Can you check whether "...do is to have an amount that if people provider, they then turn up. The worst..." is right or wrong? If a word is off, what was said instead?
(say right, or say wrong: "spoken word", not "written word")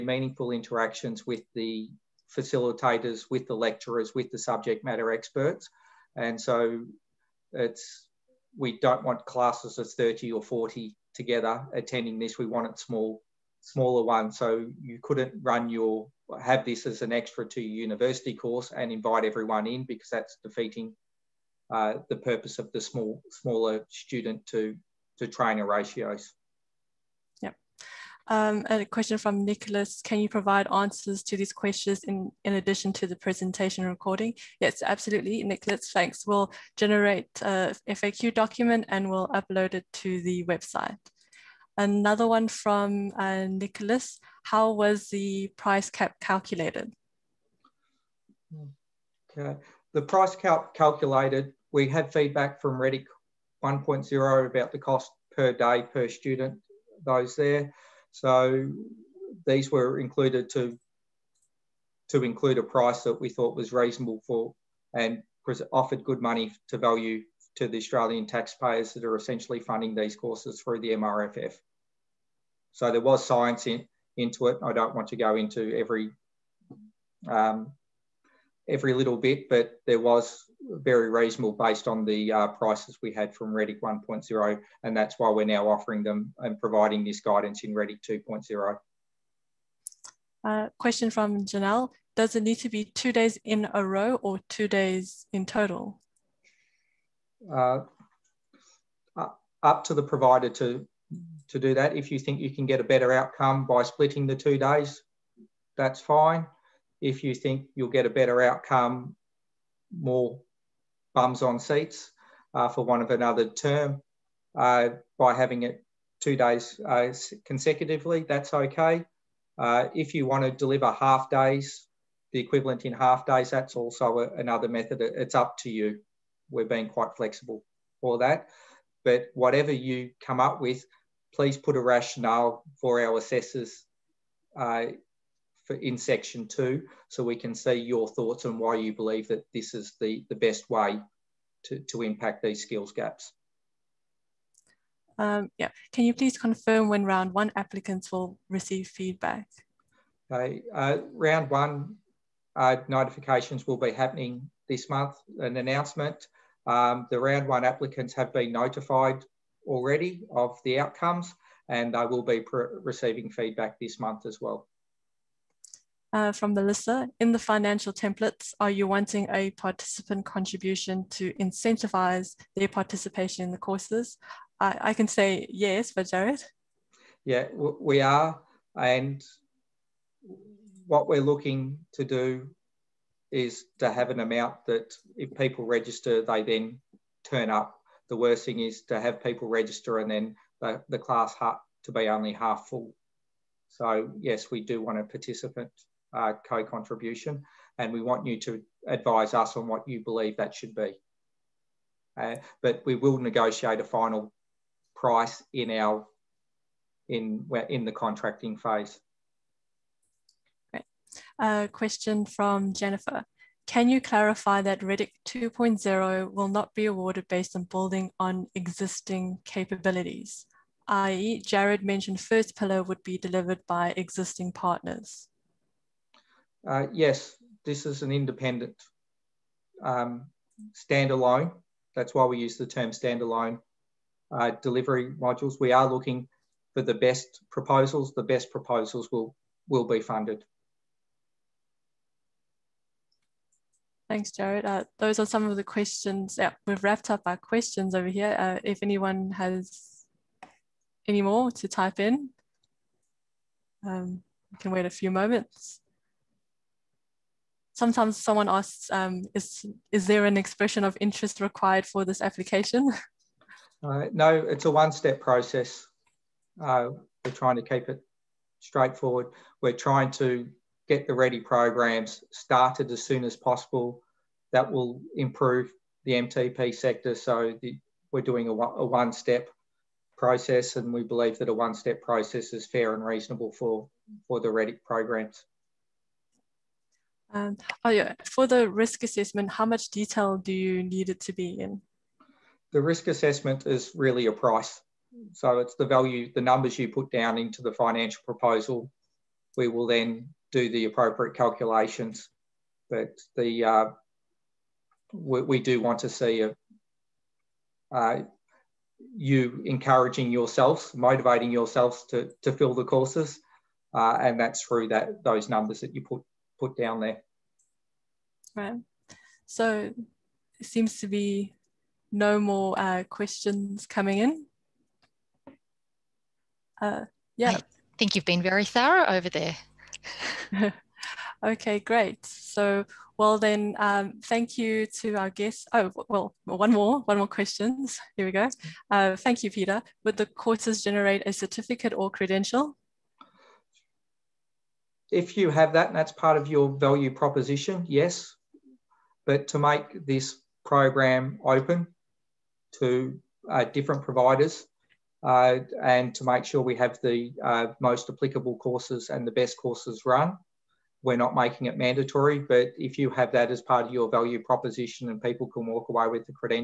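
wrong: "register", not "provider".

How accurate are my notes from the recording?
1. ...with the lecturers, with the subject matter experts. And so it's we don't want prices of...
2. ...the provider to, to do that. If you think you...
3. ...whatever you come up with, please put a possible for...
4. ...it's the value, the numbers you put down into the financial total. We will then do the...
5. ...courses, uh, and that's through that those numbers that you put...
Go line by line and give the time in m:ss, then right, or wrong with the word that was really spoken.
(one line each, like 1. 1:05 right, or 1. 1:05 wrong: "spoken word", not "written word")
1. 0:03 wrong: "classes", not "prices"
2. 1:39 right
3. 2:09 wrong: "rationale", not "possible"
4. 4:55 wrong: "proposal", not "total"
5. 5:12 right.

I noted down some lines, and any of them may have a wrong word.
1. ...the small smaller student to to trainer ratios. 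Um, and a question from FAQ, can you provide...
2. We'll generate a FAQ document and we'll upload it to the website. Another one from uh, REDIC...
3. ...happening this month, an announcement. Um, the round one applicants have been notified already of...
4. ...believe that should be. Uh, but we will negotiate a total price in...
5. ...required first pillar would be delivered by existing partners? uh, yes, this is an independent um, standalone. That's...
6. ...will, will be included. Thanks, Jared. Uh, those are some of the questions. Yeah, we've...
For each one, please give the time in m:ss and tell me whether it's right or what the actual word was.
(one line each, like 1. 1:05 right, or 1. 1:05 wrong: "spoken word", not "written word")
1. 0:22 wrong: "Nicholas", not "FAQ"
2. 0:36 wrong: "Nicholas", not "REDIC"
3. 2:33 right
4. 3:20 wrong: "final", not "total"
5. 3:41 wrong: "mentioned", not "required"
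6. 3:59 wrong: "funded", not "included".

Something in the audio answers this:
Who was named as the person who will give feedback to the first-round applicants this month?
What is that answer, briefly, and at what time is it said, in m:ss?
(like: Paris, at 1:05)
Melissa, at 2:46.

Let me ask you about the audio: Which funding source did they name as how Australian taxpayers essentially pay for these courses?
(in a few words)
MRFF.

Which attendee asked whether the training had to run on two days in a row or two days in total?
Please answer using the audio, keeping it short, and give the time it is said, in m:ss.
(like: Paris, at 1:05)
Janelle, at 1:31.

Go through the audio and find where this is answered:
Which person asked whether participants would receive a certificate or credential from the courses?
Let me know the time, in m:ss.
5:39.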